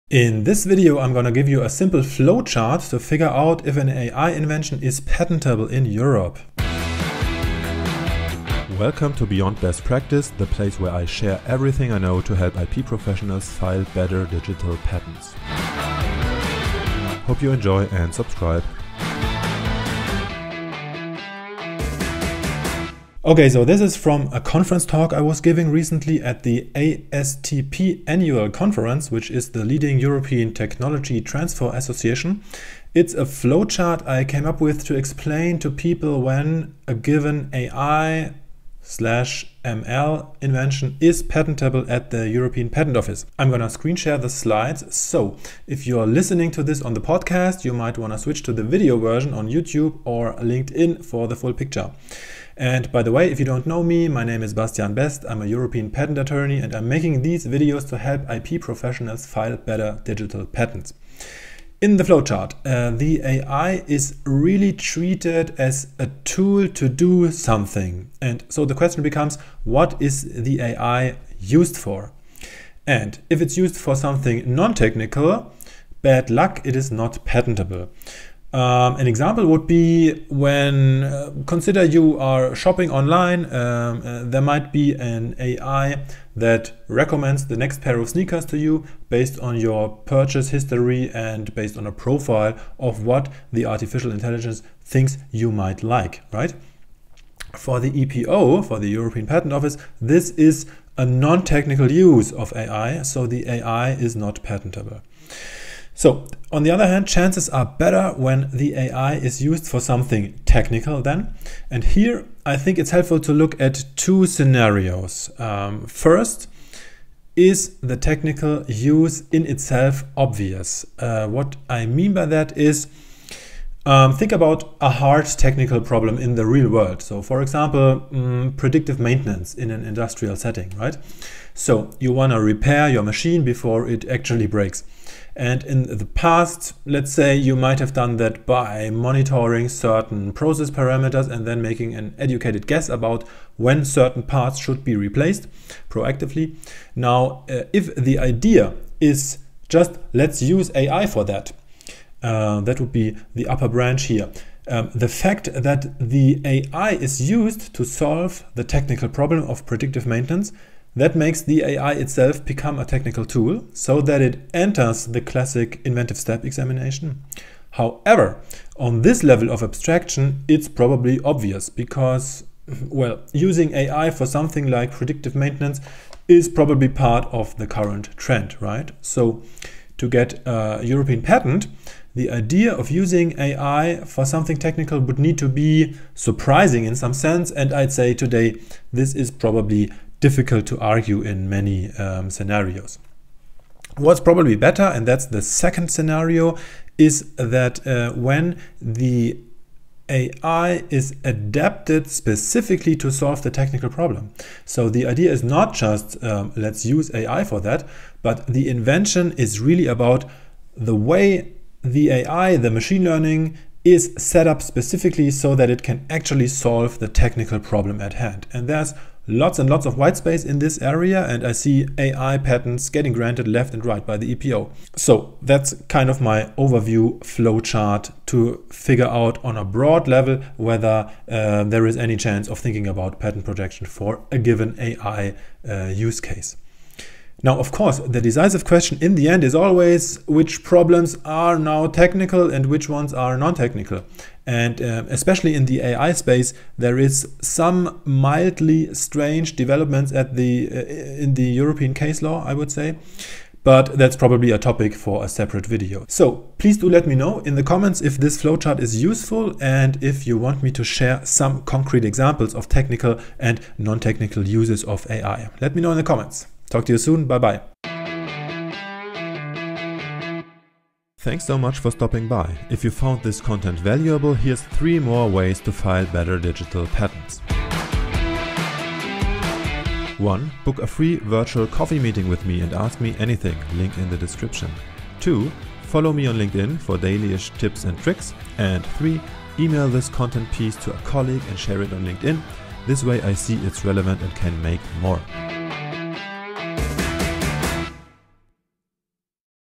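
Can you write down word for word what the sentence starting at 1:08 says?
And so the question becomes, what is the AI used for?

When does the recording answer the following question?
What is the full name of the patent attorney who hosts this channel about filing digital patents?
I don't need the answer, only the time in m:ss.
0:54.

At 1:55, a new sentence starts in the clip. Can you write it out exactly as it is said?
Um, first, is the technical use in itself obvious?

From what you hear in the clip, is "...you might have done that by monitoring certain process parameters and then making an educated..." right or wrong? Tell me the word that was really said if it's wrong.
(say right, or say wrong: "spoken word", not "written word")
right.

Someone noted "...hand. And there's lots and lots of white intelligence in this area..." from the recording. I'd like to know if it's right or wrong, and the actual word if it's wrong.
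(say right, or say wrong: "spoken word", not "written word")
wrong: "space", not "intelligence".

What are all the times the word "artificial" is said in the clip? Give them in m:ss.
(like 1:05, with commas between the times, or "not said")
1:33.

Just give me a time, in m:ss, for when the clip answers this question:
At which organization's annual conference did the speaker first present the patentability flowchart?
0:26.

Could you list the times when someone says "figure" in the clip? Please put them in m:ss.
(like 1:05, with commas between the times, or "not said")
0:02, 3:48.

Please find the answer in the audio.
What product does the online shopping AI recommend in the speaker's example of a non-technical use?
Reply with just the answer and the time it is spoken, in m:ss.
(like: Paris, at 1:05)
sneakers, at 1:28.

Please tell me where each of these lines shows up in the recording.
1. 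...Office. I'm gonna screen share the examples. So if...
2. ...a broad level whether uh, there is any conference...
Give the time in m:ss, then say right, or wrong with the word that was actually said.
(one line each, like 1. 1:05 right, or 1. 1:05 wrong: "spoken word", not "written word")
1. 0:42 wrong: "slides", not "examples"
2. 3:49 wrong: "chance", not "conference".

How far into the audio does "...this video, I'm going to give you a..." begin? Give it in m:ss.
0:00.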